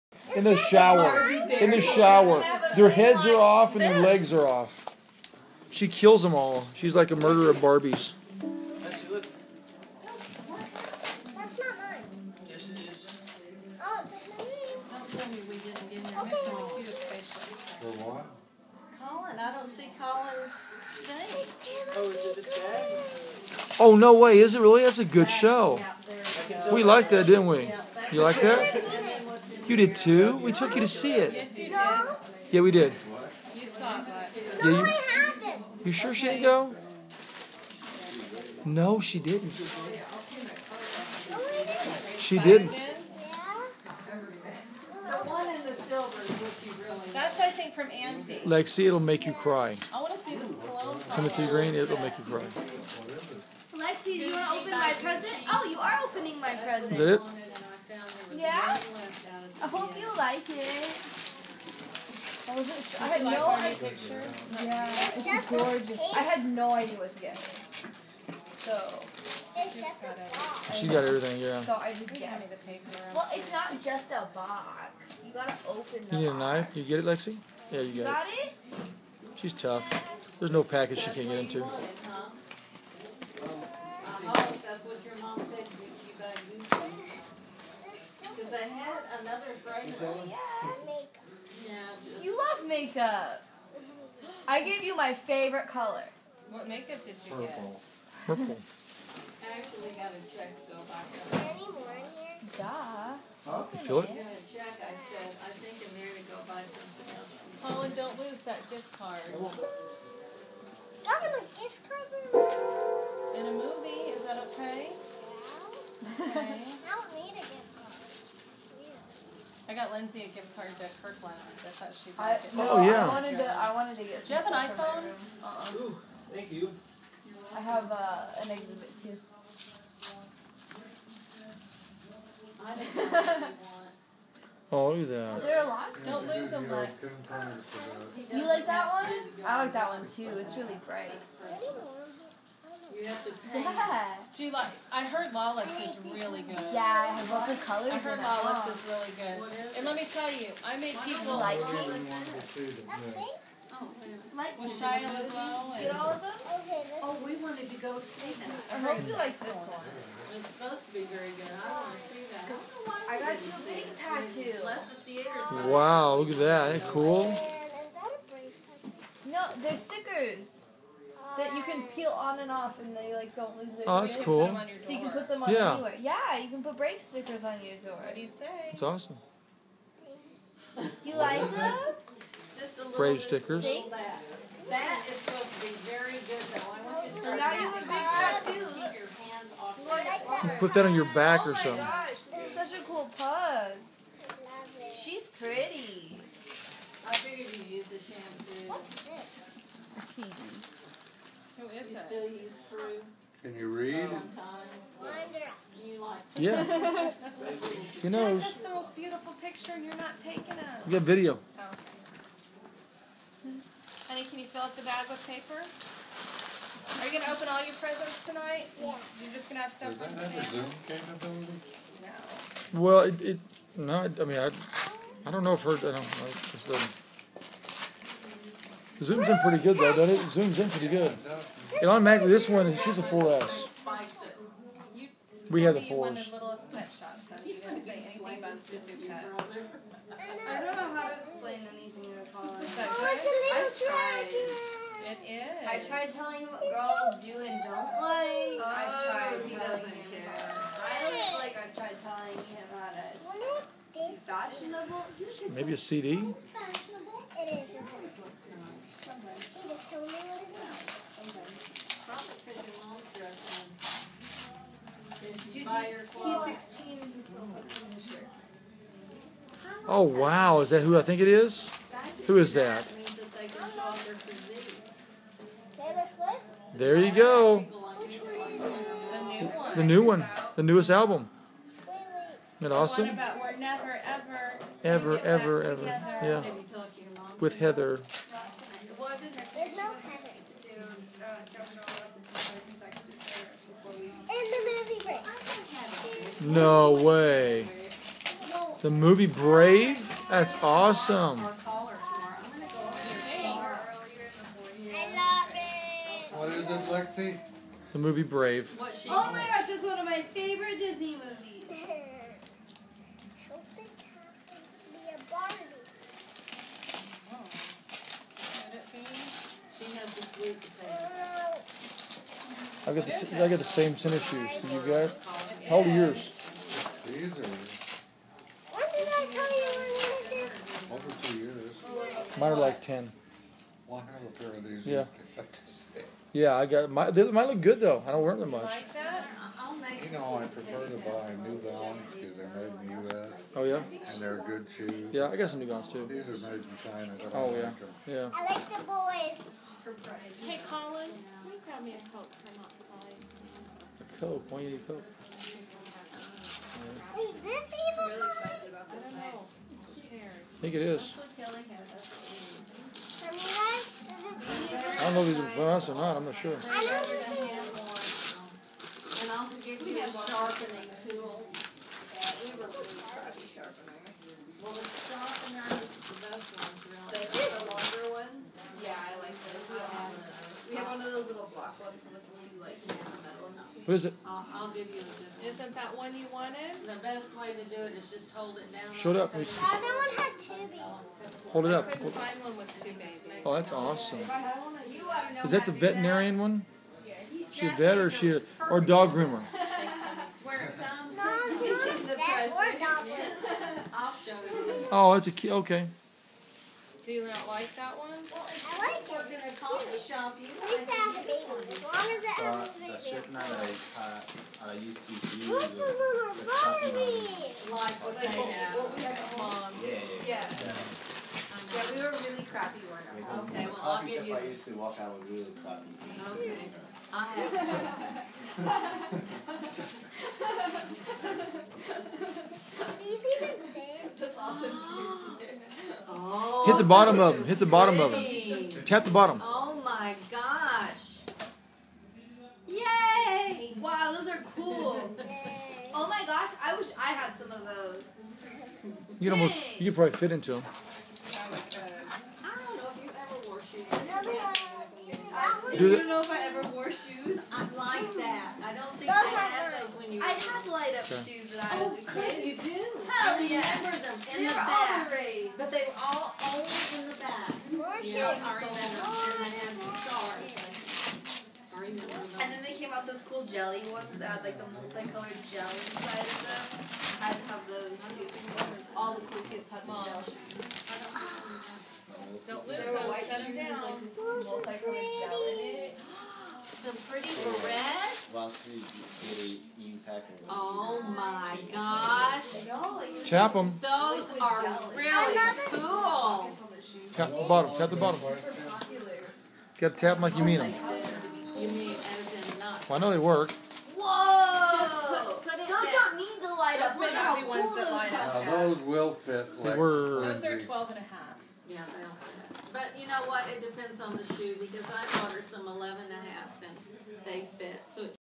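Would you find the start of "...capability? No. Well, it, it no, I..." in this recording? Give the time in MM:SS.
03:40.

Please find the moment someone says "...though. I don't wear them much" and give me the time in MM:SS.
05:37.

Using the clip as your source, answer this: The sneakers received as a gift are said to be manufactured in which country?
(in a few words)
China.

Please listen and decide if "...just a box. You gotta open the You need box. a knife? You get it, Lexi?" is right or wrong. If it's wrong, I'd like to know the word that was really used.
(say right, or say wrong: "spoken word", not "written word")
right.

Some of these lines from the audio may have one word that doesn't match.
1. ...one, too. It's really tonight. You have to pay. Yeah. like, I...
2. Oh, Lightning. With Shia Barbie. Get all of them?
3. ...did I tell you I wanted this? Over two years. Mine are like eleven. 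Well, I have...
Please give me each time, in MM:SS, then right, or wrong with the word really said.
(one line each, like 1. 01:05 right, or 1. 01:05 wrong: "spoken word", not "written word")
1. 02:19 wrong: "bright", not "tonight"
2. 02:33 wrong: "LaBeouf", not "Barbie"
3. 05:28 wrong: "ten", not "eleven".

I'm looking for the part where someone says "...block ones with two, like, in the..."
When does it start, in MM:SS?
06:21.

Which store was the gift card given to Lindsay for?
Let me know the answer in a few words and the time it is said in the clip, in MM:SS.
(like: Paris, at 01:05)
Kirkland, at 02:01.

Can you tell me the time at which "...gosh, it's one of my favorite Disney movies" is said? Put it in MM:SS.
05:09.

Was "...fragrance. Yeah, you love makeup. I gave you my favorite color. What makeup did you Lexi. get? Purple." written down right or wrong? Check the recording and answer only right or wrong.
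wrong.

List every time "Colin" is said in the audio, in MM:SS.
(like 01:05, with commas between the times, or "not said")
01:47, 04:02, 05:50.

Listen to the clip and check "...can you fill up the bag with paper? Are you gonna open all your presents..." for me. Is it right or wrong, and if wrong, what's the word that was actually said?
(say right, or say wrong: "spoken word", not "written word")
right.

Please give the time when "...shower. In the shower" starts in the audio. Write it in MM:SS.
00:00.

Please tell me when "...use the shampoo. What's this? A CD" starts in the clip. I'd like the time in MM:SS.
03:17.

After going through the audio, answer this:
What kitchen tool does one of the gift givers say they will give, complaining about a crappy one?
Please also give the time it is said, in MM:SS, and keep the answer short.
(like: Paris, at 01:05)
sharpening tool, at 06:10.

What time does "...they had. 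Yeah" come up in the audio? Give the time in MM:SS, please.
06:58.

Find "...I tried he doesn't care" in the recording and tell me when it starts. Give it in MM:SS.
04:08.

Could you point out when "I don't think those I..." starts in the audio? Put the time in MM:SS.
07:38.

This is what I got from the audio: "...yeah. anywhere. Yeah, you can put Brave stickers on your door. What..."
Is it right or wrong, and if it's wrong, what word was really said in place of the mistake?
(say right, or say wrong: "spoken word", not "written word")
right.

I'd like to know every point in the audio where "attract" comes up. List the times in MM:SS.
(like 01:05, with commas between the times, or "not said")
not said.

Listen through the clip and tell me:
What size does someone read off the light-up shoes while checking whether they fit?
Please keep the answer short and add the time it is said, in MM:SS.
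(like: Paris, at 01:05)
12 and a half, at 08:30.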